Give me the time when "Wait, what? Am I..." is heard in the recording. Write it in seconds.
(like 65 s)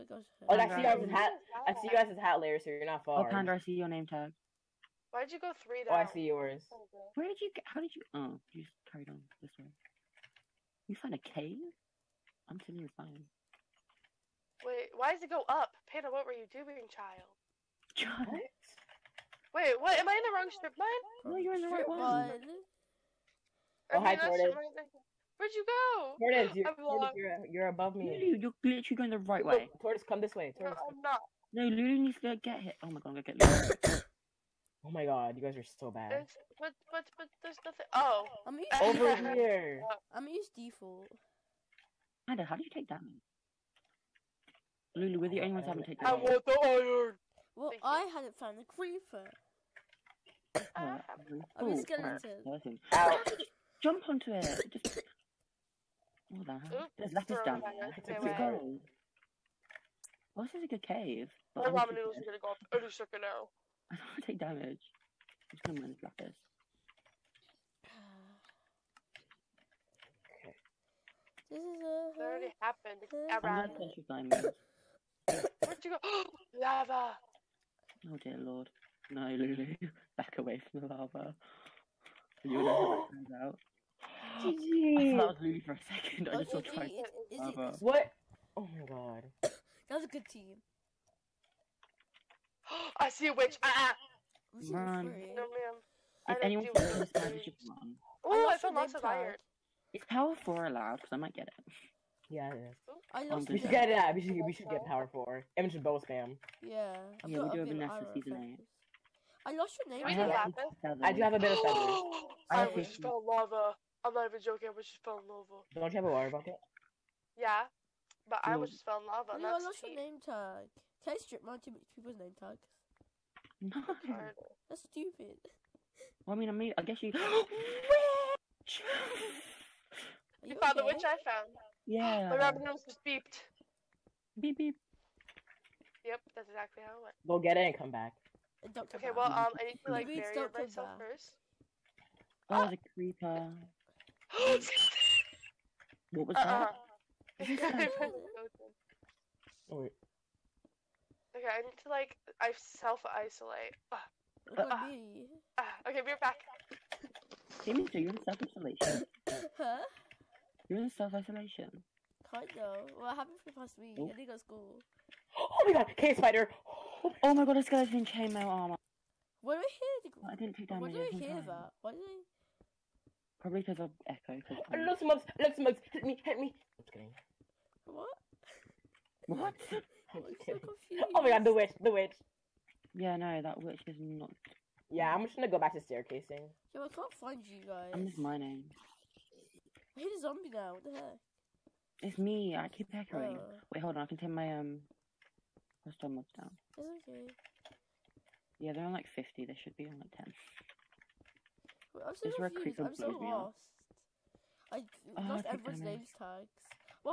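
19 s.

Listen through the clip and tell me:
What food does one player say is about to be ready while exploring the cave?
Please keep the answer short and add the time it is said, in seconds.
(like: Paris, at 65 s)
ramen noodles, at 61 s.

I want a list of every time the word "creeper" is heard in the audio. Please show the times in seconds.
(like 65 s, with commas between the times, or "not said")
48 s, 142 s.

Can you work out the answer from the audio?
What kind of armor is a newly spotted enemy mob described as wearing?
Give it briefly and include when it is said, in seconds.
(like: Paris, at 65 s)
chainmail armor, at 168 s.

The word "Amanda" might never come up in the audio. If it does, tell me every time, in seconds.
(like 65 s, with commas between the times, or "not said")
42 s.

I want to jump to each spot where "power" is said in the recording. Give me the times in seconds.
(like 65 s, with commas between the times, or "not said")
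100 s, 104 s.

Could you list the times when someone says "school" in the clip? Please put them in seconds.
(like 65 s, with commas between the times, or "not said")
164 s.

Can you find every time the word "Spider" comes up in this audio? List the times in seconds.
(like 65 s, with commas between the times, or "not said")
166 s.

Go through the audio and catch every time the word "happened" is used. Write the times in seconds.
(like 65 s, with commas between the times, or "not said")
72 s, 163 s.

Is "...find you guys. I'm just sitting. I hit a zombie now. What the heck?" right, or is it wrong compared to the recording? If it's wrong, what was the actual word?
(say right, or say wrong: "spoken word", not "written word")
wrong: "mining", not "sitting".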